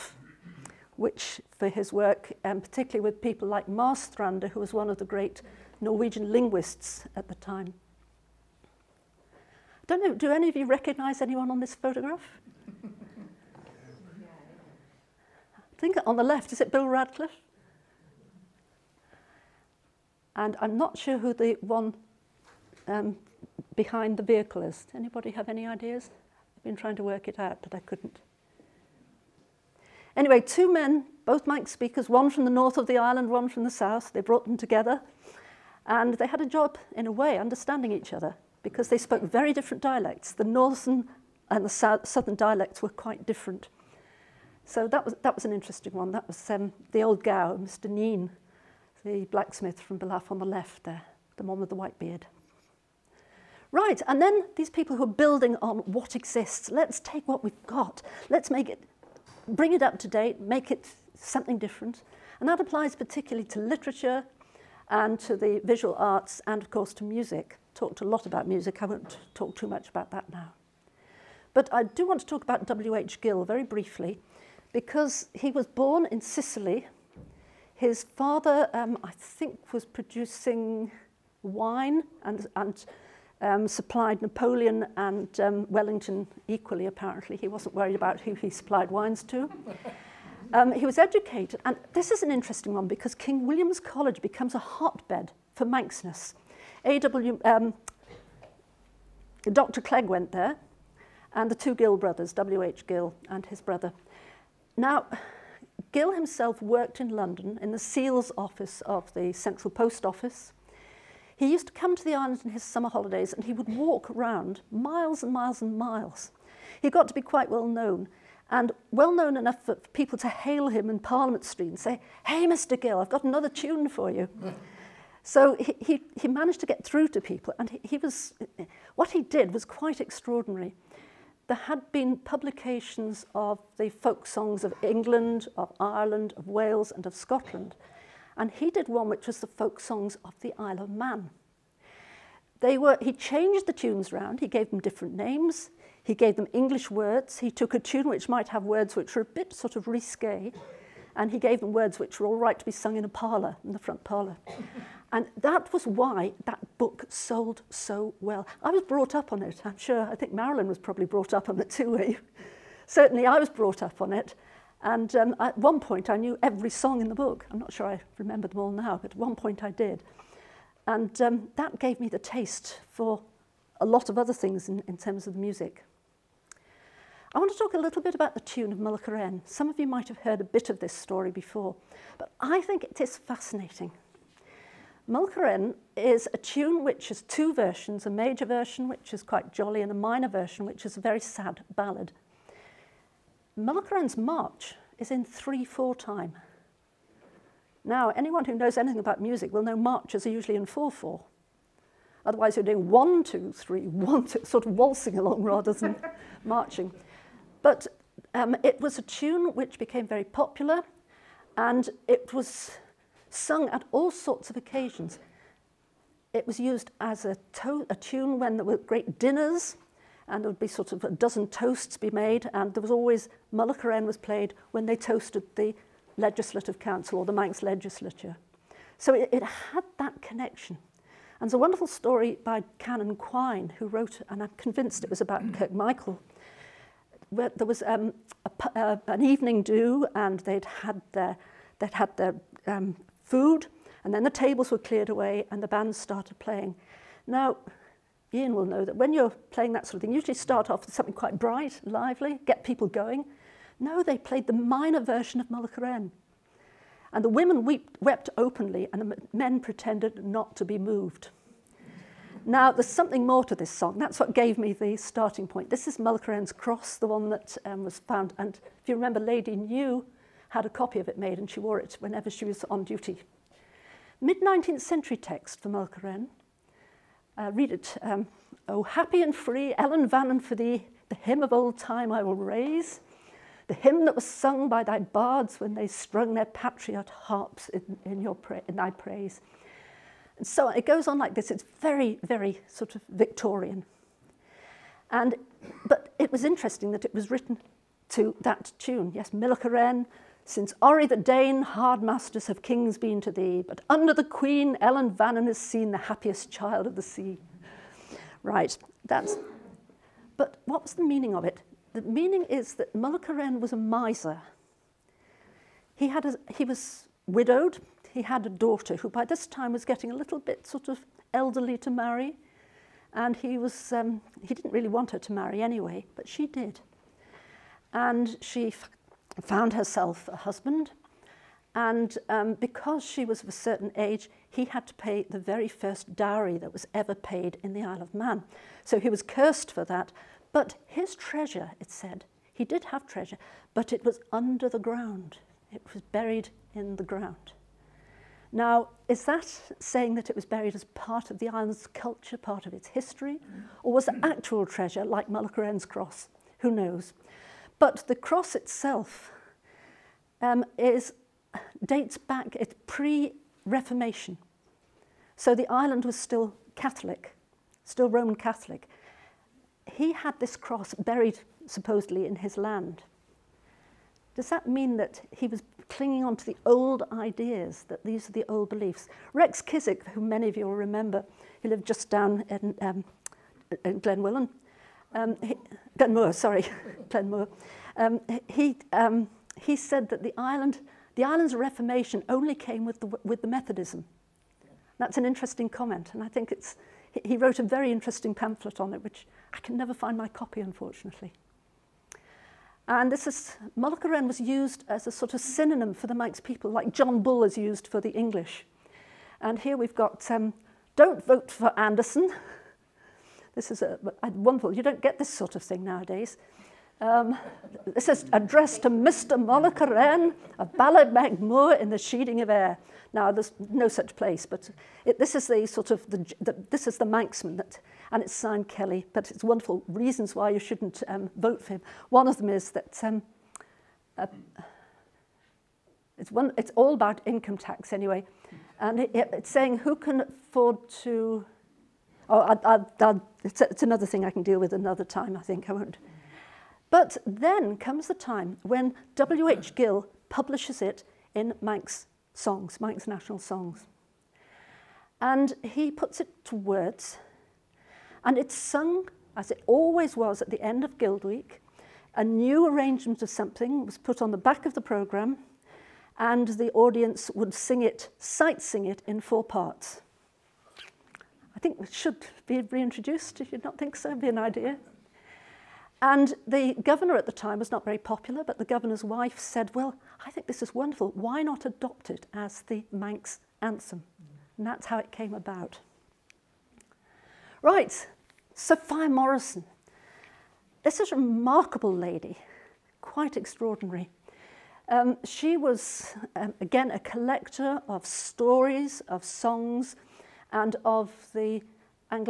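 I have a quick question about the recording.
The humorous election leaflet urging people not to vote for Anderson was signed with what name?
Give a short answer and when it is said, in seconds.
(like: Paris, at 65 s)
Kelly, at 428 s.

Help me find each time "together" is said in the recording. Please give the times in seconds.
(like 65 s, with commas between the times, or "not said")
34 s.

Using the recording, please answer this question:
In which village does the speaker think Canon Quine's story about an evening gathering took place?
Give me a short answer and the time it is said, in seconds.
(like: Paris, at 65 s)
Kirkmichael, at 235 s.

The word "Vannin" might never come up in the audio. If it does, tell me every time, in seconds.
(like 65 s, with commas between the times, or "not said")
280 s, 305 s.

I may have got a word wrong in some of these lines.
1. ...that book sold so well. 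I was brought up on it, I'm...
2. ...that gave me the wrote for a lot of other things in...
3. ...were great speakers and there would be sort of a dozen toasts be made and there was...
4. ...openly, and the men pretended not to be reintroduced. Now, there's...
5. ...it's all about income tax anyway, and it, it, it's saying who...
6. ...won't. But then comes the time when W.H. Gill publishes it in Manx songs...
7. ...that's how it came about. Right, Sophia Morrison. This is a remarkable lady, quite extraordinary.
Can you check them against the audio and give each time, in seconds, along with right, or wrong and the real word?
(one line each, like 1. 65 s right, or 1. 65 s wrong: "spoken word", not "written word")
1. 156 s right
2. 171 s wrong: "taste", not "wrote"
3. 218 s wrong: "dinners", not "speakers"
4. 258 s wrong: "moved", not "reintroduced"
5. 436 s right
6. 445 s right
7. 484 s right.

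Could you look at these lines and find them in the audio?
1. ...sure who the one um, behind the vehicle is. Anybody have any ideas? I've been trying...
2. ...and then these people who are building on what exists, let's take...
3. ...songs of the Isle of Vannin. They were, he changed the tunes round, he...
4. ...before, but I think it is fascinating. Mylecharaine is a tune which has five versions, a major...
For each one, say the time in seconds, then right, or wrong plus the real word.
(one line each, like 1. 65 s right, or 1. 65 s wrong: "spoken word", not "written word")
1. 20 s right
2. 54 s right
3. 139 s wrong: "Man", not "Vannin"
4. 181 s wrong: "two", not "five".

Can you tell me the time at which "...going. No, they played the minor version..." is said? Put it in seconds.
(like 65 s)
252 s.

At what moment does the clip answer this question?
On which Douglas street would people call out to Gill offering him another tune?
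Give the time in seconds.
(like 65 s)
120 s.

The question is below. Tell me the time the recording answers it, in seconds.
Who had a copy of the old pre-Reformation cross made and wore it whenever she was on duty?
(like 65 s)
269 s.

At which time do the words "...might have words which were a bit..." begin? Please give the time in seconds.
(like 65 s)
148 s.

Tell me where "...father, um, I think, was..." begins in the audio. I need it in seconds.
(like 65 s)
78 s.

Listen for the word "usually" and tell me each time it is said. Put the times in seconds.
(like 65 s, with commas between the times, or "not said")
200 s, 250 s.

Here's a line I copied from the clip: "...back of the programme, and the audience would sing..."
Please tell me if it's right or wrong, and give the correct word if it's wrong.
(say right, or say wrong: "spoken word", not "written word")
right.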